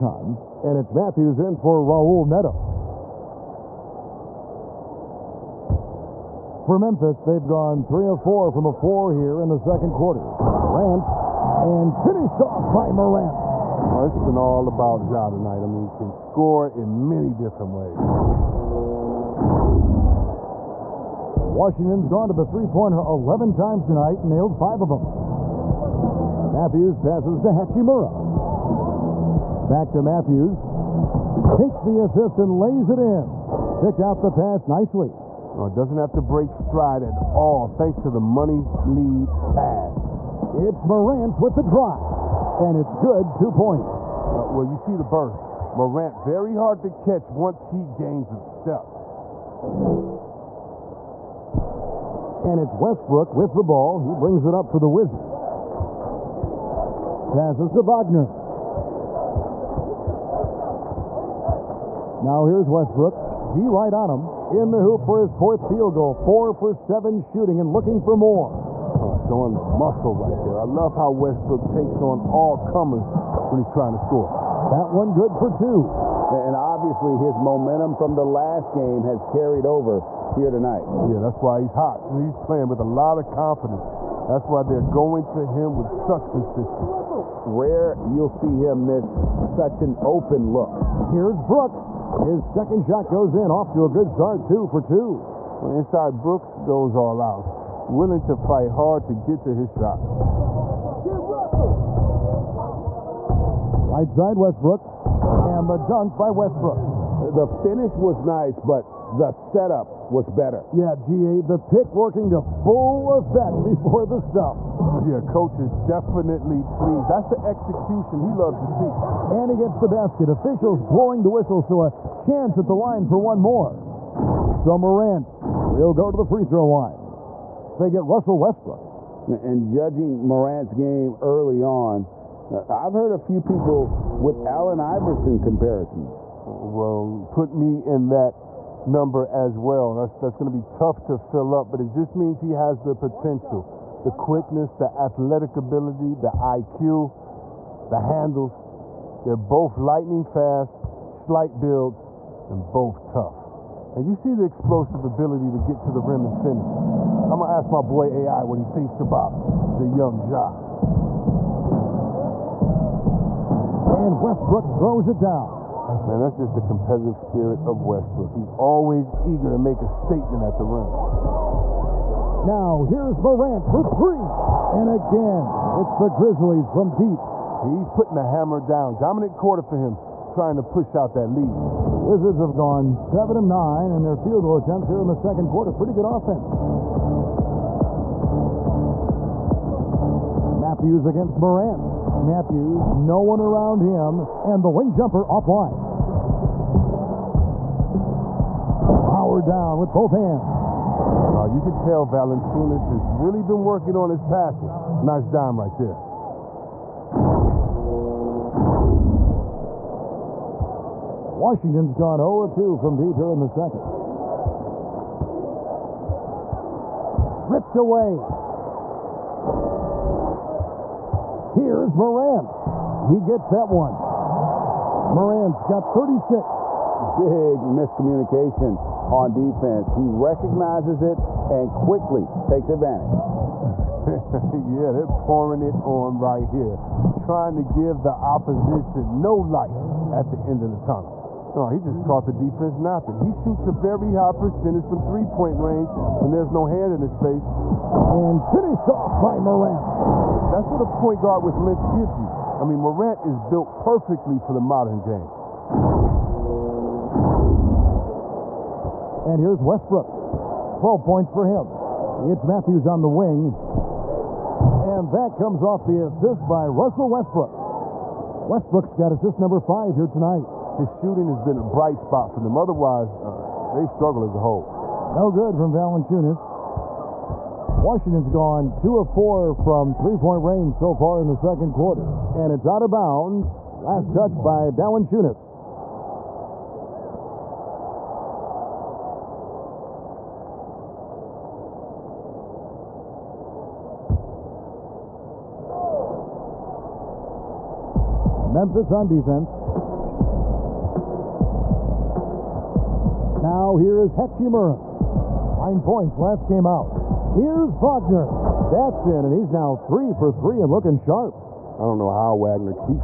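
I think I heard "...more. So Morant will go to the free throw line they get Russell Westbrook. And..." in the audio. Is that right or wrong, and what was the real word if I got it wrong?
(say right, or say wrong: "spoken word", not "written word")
right.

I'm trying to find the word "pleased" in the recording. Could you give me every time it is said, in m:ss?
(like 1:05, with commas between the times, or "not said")
1:56.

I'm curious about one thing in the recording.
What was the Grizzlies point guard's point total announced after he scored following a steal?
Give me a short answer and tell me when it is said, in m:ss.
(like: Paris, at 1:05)
36, at 3:45.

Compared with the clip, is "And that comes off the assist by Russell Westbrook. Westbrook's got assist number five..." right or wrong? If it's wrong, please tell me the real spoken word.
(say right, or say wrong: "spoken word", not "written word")
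right.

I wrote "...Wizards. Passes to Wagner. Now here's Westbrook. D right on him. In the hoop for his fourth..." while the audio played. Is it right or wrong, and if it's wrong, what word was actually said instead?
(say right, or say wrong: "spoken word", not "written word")
right.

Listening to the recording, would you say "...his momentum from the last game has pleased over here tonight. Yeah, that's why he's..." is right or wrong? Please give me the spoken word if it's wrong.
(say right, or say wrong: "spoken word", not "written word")
wrong: "carried", not "pleased".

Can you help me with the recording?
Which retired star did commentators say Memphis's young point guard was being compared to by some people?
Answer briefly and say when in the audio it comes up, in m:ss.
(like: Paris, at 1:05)
Allen Iverson, at 2:14.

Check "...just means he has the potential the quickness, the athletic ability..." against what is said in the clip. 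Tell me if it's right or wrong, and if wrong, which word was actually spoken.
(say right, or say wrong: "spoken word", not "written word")
right.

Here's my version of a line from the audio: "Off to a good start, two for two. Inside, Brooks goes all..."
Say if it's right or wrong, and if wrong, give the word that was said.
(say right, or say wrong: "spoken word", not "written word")
right.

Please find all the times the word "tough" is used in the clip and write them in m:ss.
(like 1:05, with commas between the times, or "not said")
2:20, 2:33.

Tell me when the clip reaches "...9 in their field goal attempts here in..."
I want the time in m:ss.
3:03.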